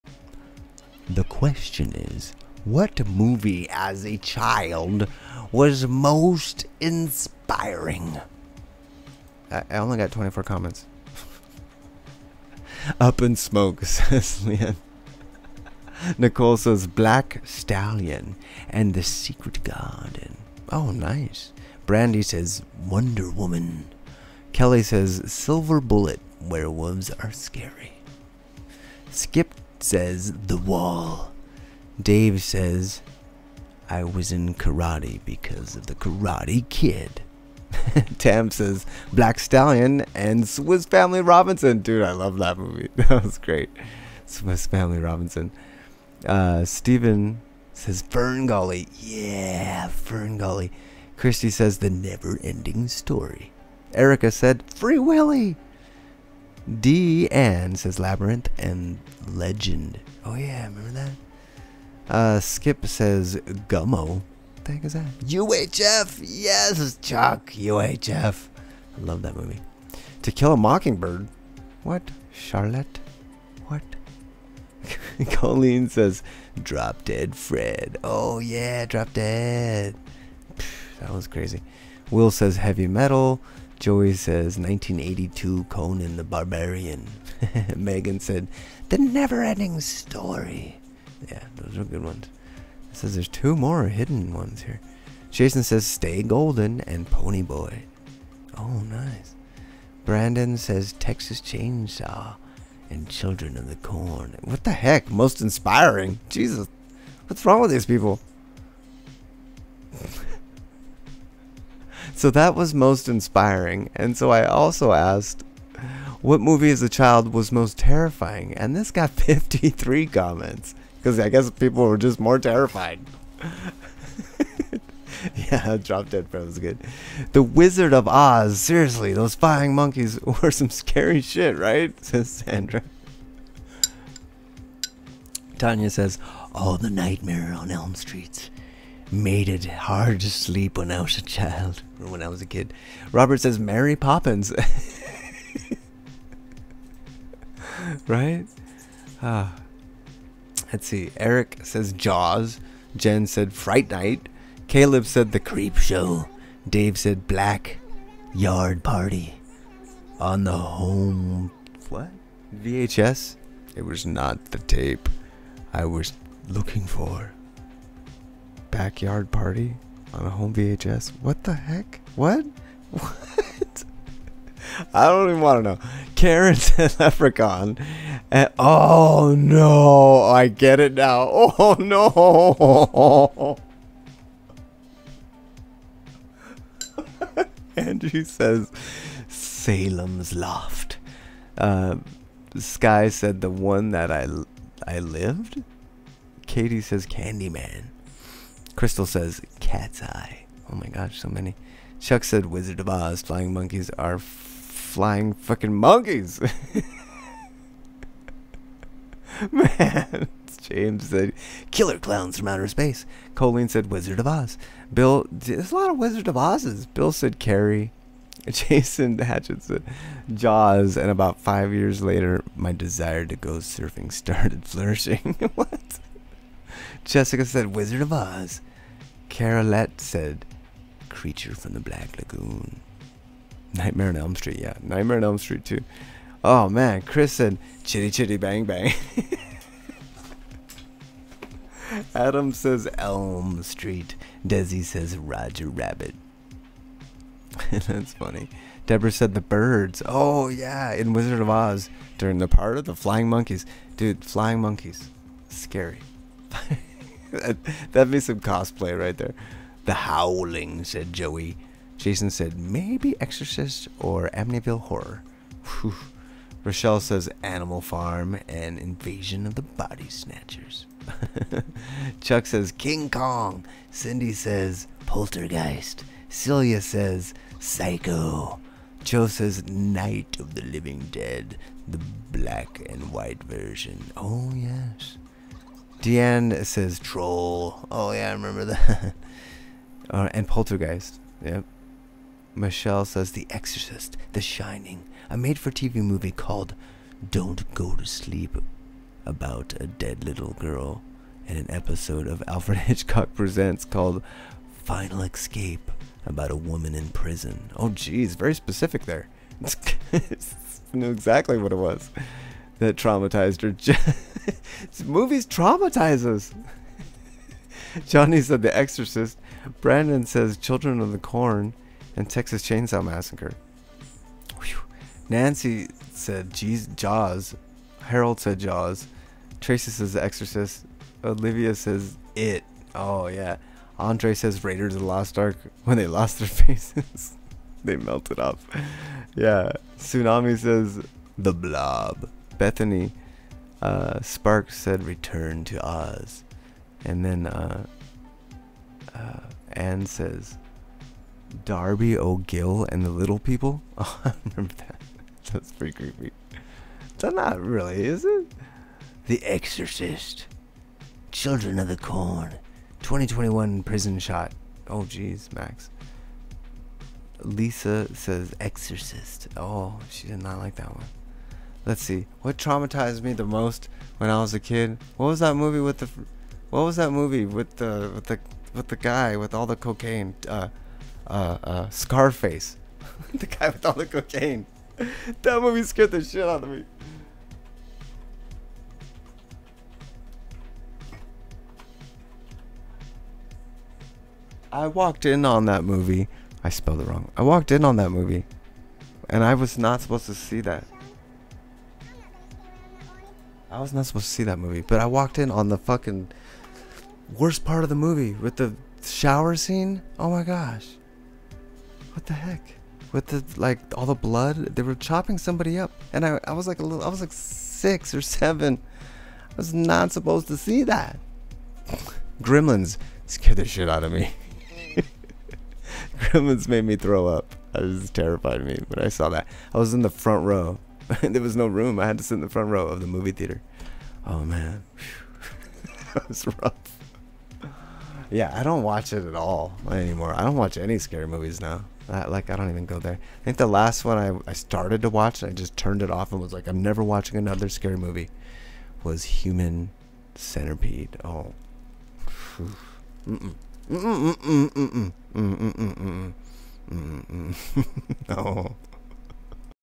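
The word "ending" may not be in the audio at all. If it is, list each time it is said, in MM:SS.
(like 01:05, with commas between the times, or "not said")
00:52, 01:28.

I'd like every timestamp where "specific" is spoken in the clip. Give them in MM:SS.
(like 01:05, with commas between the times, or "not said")
05:08.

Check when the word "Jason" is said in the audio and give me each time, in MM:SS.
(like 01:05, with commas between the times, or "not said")
01:35, 03:38, 04:21.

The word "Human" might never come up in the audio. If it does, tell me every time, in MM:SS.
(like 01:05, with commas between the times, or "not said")
07:29.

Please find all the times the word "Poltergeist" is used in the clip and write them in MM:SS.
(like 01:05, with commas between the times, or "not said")
04:35, 04:50.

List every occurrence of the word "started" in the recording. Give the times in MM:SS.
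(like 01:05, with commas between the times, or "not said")
03:44, 07:24.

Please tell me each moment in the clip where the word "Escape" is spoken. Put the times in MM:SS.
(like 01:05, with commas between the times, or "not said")
05:05.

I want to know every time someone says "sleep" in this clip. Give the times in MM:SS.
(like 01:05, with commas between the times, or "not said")
02:20, 04:58.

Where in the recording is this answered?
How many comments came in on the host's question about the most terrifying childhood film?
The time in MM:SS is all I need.
01:59.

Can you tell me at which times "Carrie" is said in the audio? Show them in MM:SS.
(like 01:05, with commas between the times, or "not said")
03:37.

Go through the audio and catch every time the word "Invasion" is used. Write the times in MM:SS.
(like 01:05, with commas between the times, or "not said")
04:28.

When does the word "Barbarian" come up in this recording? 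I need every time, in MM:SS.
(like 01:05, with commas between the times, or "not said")
01:26.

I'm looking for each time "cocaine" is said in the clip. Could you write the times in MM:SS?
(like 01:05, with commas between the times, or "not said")
06:19, 06:24.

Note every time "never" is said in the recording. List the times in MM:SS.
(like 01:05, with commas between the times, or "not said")
00:51, 01:28, 07:26.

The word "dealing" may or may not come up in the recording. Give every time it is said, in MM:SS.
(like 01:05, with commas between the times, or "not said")
not said.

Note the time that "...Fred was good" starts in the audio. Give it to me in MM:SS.
02:06.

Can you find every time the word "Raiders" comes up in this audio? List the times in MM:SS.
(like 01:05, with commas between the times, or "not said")
05:34.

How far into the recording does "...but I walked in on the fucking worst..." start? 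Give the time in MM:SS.
06:44.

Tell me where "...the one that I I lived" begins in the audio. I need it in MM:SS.
03:13.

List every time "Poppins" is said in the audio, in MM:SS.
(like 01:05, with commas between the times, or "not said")
02:23.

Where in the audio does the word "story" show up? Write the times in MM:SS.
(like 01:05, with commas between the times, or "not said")
00:52, 01:29.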